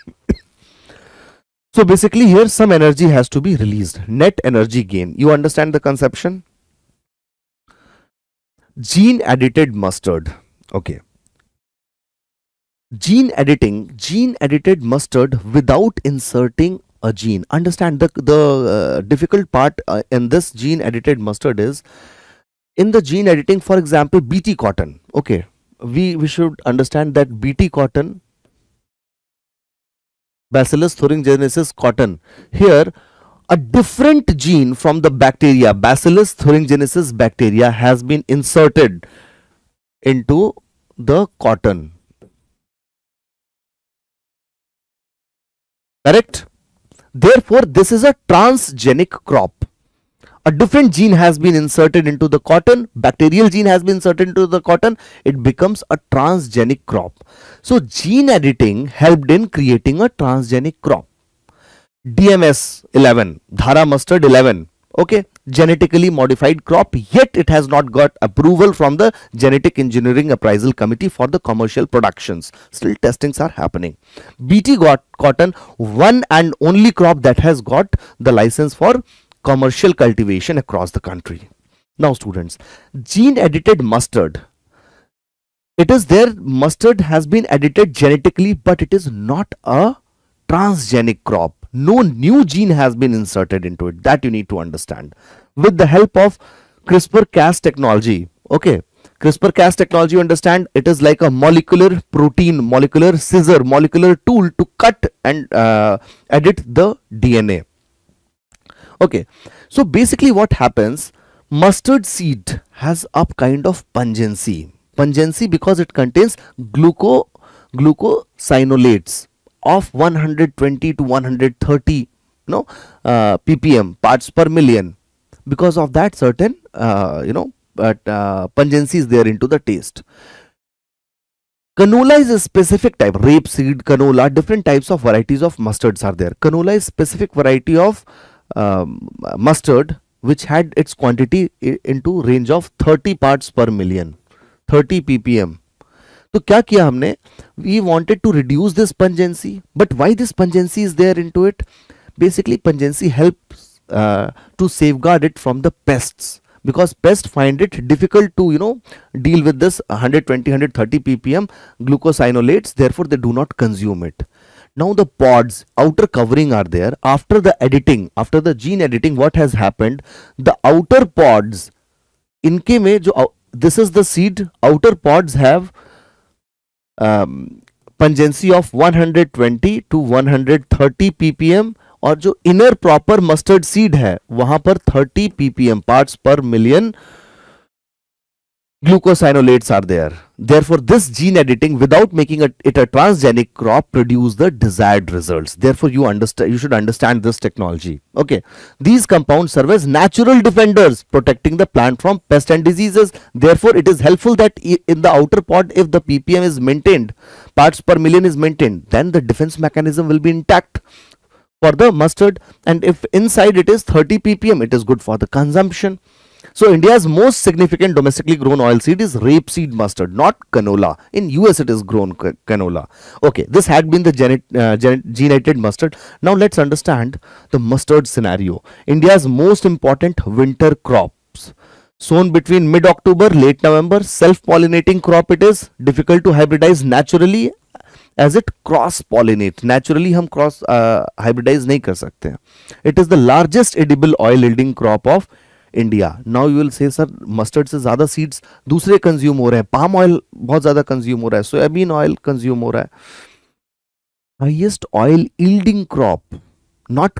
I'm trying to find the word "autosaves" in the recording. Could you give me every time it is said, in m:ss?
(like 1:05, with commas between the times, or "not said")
not said.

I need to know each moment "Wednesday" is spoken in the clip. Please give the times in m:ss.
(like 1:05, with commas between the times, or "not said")
not said.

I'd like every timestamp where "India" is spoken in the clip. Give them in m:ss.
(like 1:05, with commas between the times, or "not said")
3:36, 3:48.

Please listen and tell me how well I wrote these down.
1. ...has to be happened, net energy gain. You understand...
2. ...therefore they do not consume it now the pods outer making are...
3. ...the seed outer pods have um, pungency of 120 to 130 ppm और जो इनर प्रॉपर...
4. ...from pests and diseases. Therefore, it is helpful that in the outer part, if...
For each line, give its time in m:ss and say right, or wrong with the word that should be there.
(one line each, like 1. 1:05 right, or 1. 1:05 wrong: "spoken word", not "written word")
1. 0:03 wrong: "released", not "happened"
2. 2:42 wrong: "covering", not "making"
3. 2:53 right
4. 3:22 right.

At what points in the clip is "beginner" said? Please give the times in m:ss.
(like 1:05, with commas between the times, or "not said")
not said.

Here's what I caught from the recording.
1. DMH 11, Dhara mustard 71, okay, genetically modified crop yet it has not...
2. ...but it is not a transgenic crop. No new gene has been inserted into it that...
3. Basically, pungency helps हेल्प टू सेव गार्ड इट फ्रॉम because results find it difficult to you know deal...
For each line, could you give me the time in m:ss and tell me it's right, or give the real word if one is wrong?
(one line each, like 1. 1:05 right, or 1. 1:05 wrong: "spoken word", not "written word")
1. 1:02 wrong: "11", not "71"
2. 1:28 right
3. 2:32 wrong: "pests", not "results".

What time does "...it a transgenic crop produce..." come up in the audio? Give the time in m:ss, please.
3:12.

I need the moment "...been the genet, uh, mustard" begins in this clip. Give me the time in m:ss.
3:43.